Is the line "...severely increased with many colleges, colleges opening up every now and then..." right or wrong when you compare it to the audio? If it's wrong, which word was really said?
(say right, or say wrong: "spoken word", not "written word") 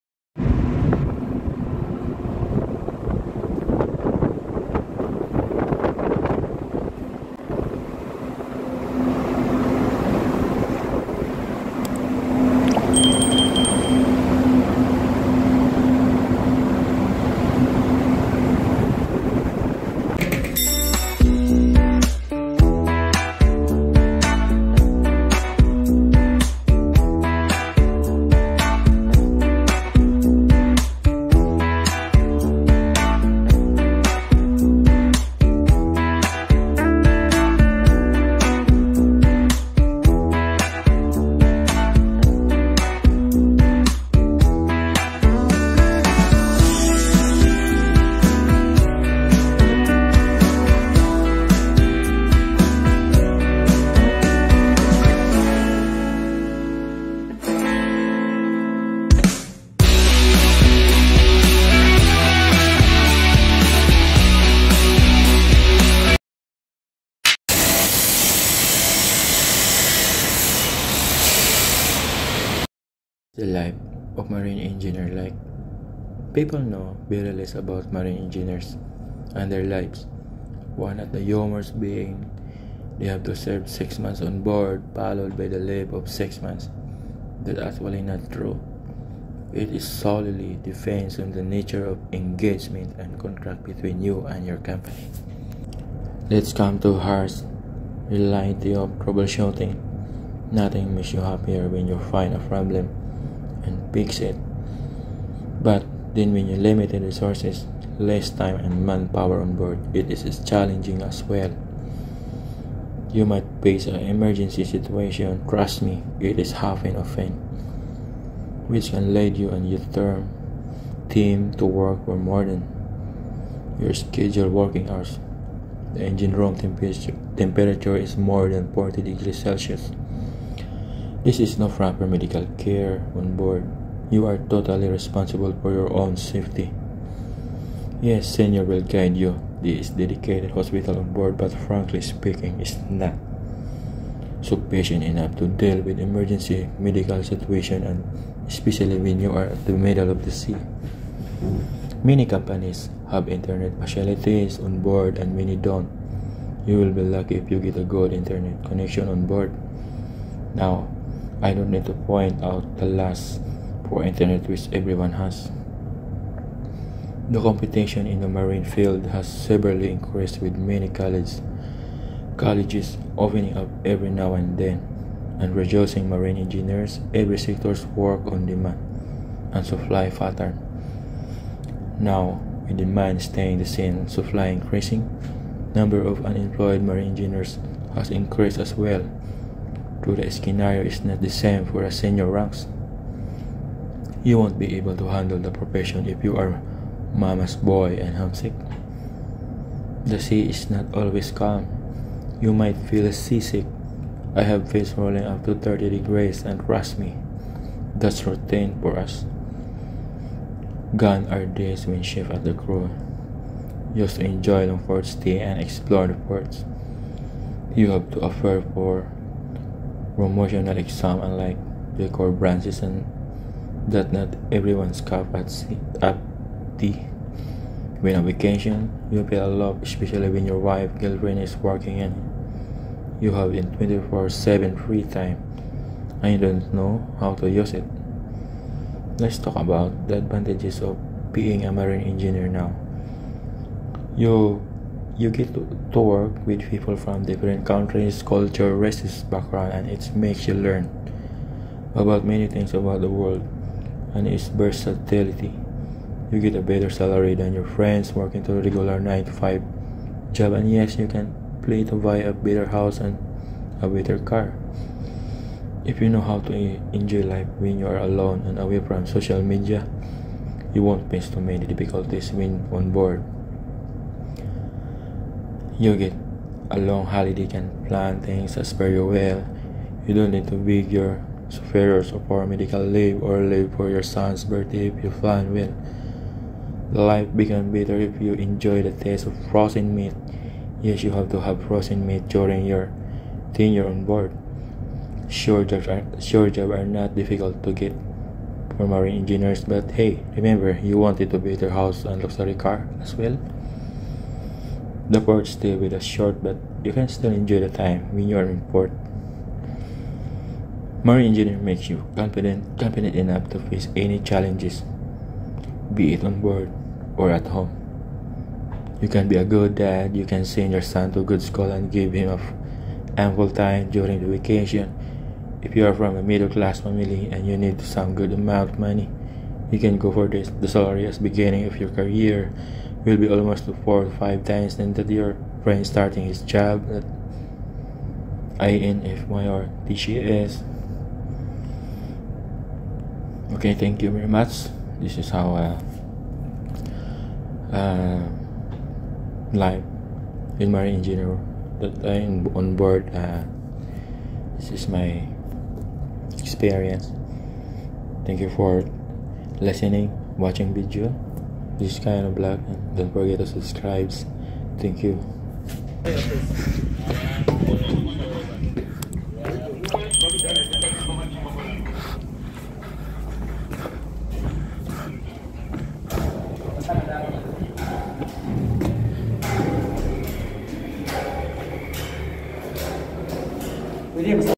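right.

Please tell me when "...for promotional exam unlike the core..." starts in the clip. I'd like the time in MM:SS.
03:38.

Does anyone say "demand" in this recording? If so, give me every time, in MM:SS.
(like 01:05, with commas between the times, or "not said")
02:58, 03:02.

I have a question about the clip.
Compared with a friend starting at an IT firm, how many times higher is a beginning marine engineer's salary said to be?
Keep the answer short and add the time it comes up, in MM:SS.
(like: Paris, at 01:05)
4 or 5 times, at 05:33.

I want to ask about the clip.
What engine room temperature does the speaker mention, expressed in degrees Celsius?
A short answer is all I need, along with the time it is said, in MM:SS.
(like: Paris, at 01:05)
More than 40 degrees Celsius, at 02:08.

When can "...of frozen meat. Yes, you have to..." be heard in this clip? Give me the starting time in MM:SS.
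04:49.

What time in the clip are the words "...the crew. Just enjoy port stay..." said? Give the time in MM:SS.
03:32.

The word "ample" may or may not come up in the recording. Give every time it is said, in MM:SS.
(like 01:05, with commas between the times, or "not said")
05:23.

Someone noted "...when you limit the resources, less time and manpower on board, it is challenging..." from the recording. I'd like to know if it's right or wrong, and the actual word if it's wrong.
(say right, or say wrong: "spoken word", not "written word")
right.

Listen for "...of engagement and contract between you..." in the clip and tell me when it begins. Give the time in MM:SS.
01:31.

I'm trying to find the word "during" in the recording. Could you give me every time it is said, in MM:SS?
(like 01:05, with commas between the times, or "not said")
04:52, 05:23.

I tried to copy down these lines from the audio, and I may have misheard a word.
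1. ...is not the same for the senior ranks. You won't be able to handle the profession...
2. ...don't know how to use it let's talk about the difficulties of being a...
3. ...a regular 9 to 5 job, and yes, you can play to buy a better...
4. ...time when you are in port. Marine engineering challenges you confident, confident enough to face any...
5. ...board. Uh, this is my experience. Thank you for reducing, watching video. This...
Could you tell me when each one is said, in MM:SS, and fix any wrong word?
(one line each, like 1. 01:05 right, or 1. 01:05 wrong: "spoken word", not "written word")
1. 03:10 right
2. 03:56 wrong: "advantages", not "difficulties"
3. 04:18 right
4. 05:07 wrong: "makes", not "challenges"
5. 05:52 wrong: "listening", not "reducing".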